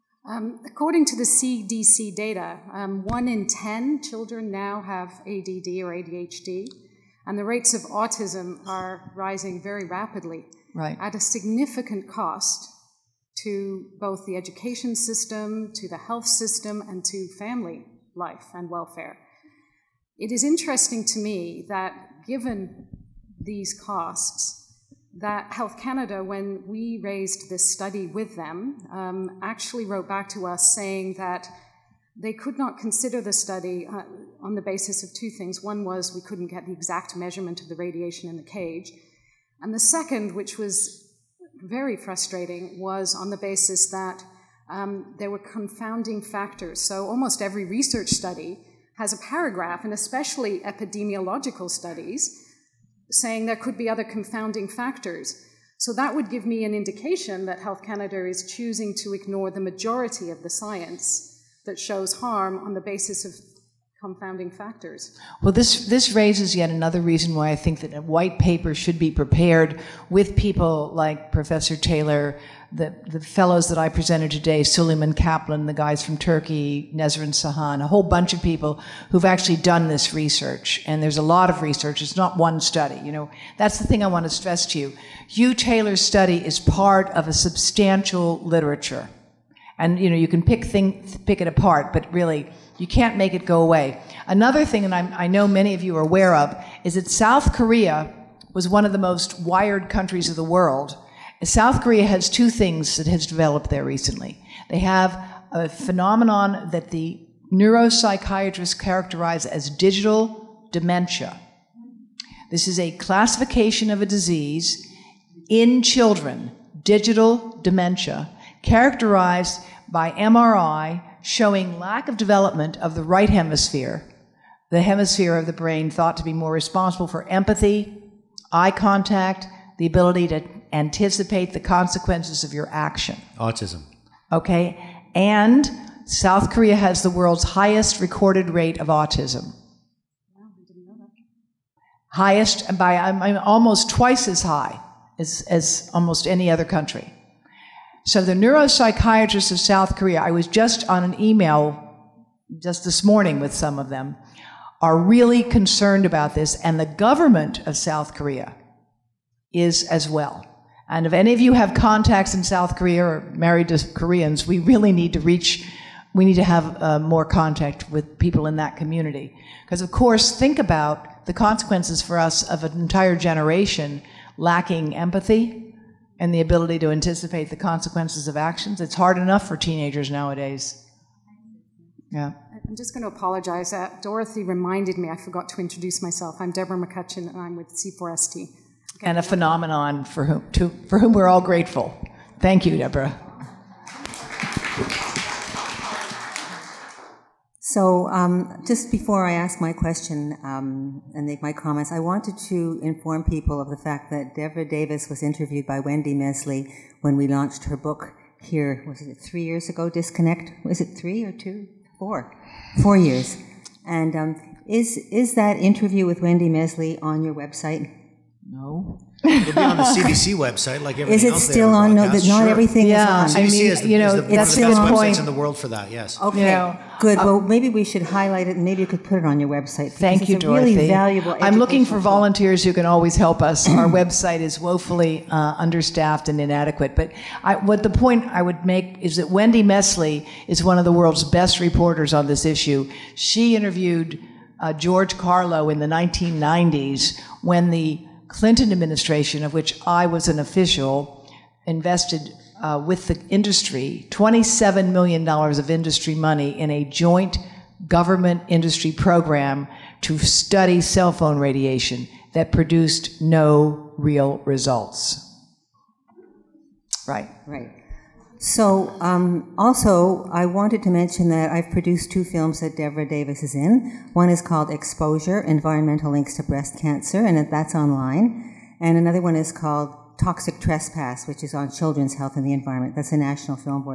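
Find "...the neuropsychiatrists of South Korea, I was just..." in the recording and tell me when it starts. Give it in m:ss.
2:28.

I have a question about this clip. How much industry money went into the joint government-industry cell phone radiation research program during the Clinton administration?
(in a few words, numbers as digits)
$27 million.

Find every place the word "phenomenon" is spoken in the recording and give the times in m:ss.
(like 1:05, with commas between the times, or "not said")
1:45, 3:09.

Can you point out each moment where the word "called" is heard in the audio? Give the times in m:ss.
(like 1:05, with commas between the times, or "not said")
4:34, 4:39.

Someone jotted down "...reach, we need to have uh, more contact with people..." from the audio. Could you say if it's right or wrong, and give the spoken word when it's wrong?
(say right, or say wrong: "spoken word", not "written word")
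right.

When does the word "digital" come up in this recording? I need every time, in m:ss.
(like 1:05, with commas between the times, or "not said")
1:49, 1:56.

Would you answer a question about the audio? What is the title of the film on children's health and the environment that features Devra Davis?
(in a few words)
Toxic Trespass.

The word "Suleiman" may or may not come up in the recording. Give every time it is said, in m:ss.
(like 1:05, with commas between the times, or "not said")
1:14.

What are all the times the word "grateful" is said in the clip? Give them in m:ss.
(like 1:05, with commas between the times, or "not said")
3:11.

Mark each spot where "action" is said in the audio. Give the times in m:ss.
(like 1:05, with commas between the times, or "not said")
2:12, 2:58.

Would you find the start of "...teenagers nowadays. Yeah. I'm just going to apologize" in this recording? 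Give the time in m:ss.
2:59.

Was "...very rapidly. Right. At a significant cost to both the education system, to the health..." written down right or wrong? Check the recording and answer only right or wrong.
right.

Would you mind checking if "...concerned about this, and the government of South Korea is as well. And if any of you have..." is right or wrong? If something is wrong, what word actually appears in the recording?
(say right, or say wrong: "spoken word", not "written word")
right.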